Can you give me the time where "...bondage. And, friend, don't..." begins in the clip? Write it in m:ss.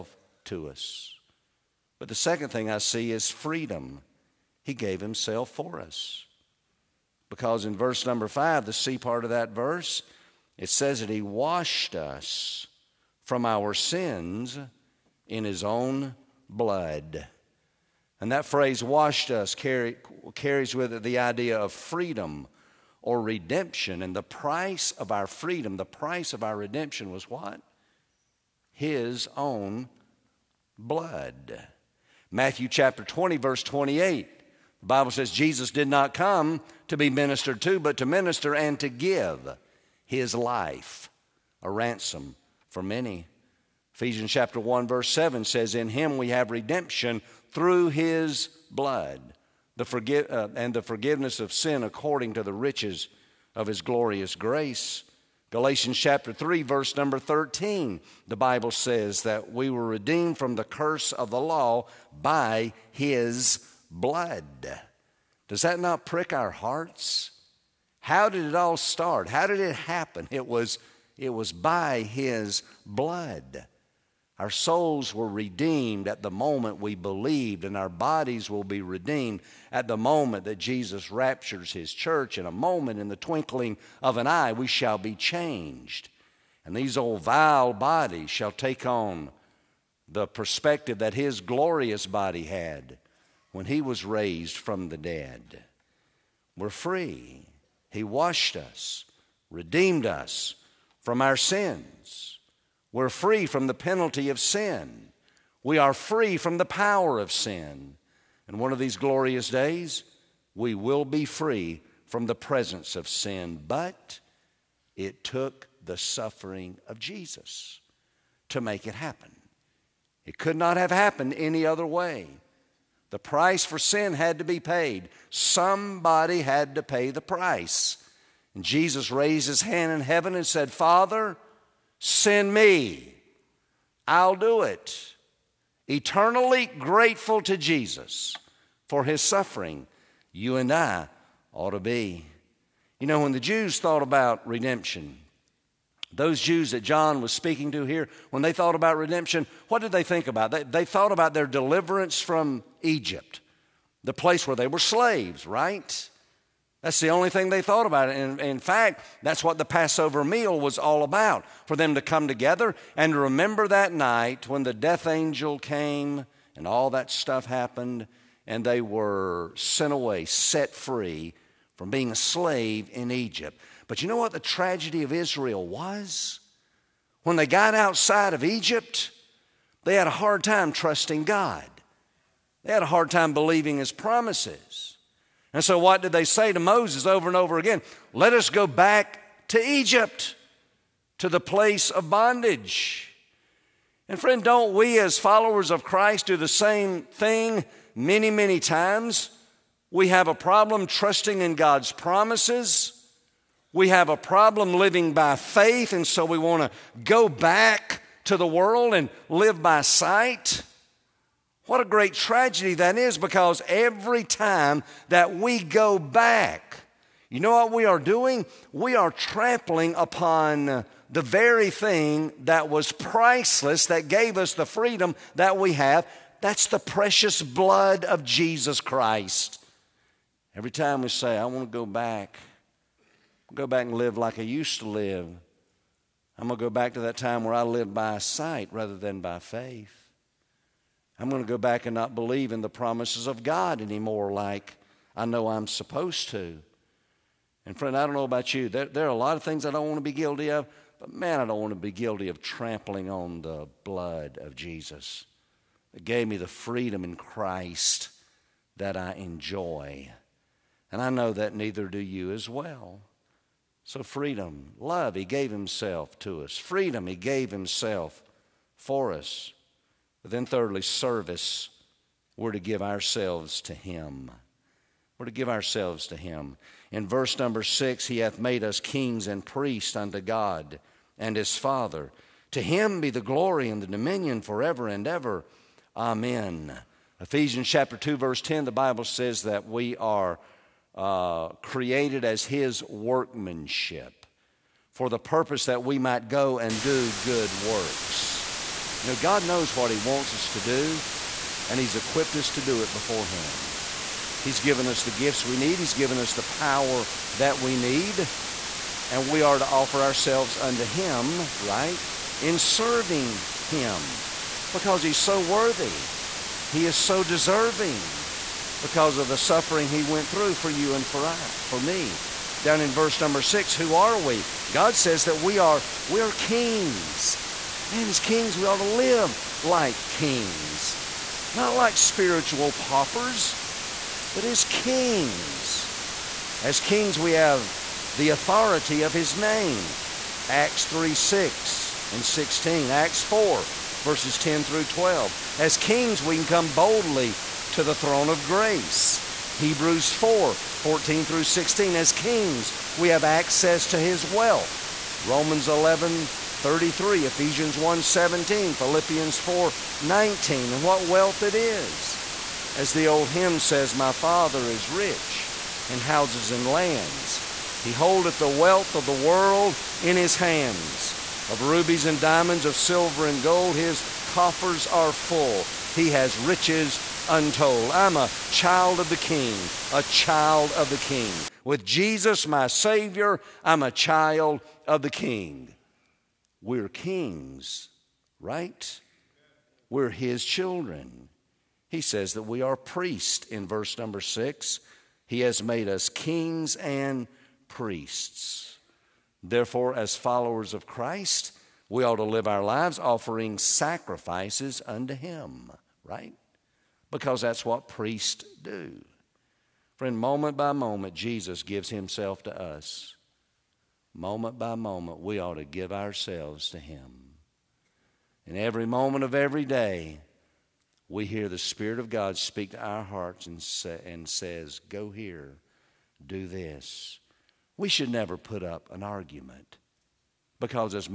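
3:12.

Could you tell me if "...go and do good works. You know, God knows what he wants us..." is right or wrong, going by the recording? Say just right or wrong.
right.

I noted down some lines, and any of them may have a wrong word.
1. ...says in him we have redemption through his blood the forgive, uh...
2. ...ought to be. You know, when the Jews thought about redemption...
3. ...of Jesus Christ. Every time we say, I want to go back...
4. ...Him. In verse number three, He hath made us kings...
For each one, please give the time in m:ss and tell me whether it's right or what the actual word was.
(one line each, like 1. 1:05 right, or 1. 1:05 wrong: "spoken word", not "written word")
1. 0:45 right
2. 2:21 right
3. 3:48 right
4. 4:36 wrong: "six", not "three".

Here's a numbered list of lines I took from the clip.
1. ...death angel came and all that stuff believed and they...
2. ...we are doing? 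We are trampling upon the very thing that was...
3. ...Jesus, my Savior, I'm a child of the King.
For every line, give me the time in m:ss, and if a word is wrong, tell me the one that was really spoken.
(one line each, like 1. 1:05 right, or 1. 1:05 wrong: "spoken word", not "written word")
1. 2:44 wrong: "happened", not "believed"
2. 3:37 right
3. 6:21 right.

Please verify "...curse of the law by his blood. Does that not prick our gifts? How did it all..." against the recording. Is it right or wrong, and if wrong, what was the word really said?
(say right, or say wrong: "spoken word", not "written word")
wrong: "hearts", not "gifts".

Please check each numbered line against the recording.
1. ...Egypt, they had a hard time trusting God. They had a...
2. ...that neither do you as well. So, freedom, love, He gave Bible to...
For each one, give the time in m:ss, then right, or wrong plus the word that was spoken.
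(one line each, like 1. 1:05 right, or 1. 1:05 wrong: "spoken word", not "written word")
1. 2:58 right
2. 4:21 wrong: "Himself", not "Bible".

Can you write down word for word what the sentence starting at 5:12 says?
In serving him because he's so worthy.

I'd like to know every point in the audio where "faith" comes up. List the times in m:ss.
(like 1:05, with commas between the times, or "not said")
3:25, 3:59.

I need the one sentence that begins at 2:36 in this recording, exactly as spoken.
That's the only thing they thought about.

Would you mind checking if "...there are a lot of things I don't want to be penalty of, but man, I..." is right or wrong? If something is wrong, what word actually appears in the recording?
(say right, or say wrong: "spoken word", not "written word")
wrong: "guilty", not "penalty".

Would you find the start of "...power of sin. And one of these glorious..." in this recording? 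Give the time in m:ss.
1:46.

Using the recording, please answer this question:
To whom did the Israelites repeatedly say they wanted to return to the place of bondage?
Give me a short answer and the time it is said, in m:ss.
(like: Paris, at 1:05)
Moses, at 3:06.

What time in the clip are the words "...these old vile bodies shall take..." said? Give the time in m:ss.
1:26.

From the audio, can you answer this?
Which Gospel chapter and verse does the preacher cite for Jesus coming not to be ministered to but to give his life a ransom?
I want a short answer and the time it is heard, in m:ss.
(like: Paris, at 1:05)
Matthew 20:28, at 0:32.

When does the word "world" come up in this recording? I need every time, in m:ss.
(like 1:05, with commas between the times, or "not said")
3:28, 6:09.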